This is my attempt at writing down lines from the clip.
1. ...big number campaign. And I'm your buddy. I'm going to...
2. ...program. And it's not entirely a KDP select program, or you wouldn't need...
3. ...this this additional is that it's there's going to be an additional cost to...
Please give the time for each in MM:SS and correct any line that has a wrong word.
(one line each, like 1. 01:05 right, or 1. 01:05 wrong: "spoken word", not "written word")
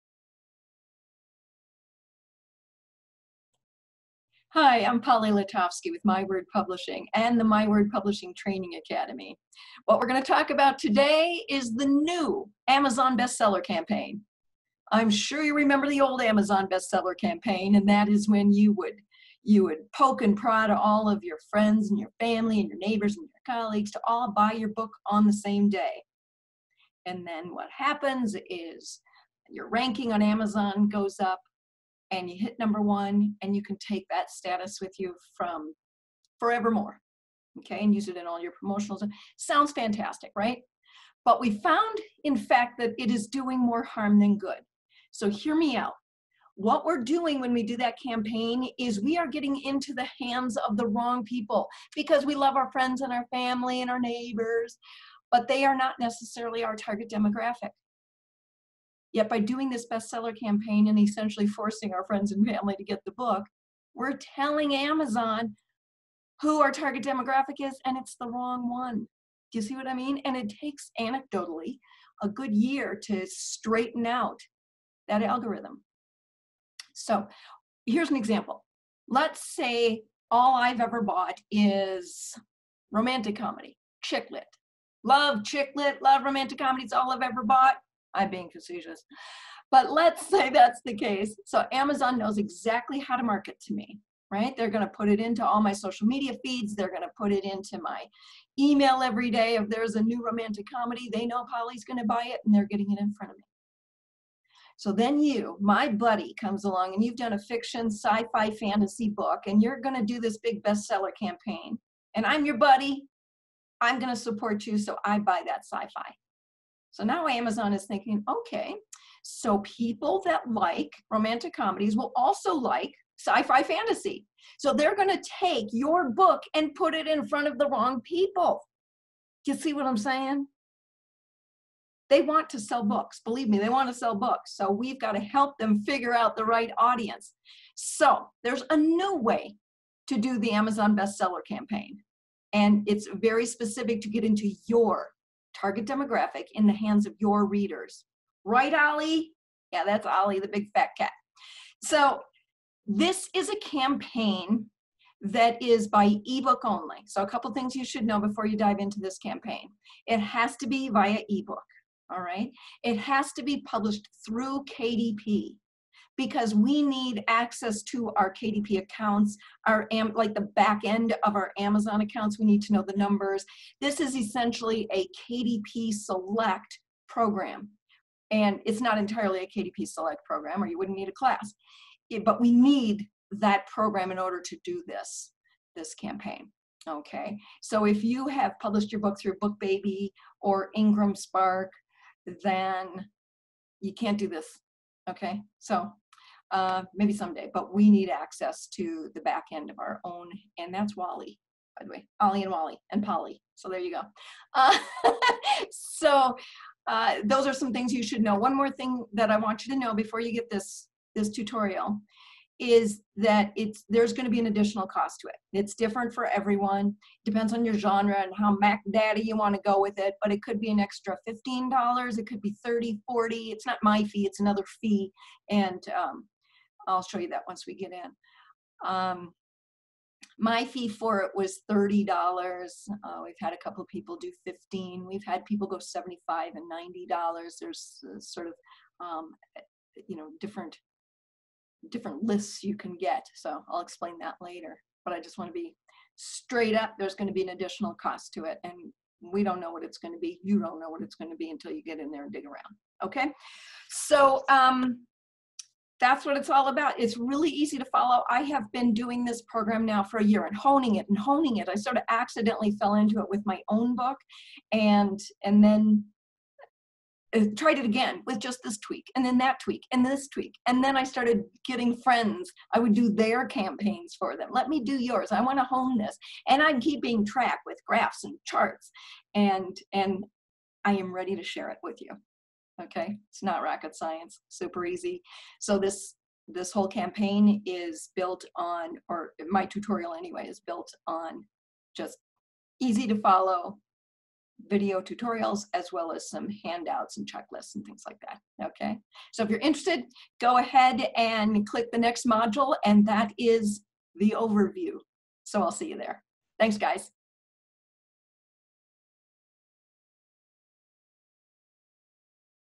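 1. 01:50 wrong: "bestseller", not "number"
2. 02:57 right
3. 03:30 wrong: "tutorial", not "additional".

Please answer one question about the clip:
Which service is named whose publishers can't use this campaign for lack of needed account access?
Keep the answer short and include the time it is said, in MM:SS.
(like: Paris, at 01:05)
Book Baby, at 03:09.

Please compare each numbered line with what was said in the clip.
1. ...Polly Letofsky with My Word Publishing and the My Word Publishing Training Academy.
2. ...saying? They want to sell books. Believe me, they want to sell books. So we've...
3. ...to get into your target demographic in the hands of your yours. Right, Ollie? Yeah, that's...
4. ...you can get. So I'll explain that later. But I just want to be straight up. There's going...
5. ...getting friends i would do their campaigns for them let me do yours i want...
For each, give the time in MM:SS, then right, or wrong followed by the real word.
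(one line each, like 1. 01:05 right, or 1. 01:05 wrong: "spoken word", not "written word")
1. 00:04 right
2. 02:09 right
3. 02:24 wrong: "readers", not "yours"
4. 04:02 right
5. 04:31 right.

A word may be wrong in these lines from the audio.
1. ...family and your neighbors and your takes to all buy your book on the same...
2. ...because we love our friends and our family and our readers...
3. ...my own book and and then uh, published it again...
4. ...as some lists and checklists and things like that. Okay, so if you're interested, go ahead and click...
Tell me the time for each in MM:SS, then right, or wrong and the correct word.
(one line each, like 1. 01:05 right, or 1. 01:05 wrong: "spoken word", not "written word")
1. 00:22 wrong: "colleagues", not "takes"
2. 00:51 wrong: "neighbors", not "readers"
3. 04:23 wrong: "tried", not "published"
4. 04:56 wrong: "handouts", not "lists".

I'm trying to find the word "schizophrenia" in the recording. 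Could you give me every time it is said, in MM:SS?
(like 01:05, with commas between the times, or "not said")
not said.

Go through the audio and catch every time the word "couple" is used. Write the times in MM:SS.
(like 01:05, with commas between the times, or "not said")
02:37, 03:53.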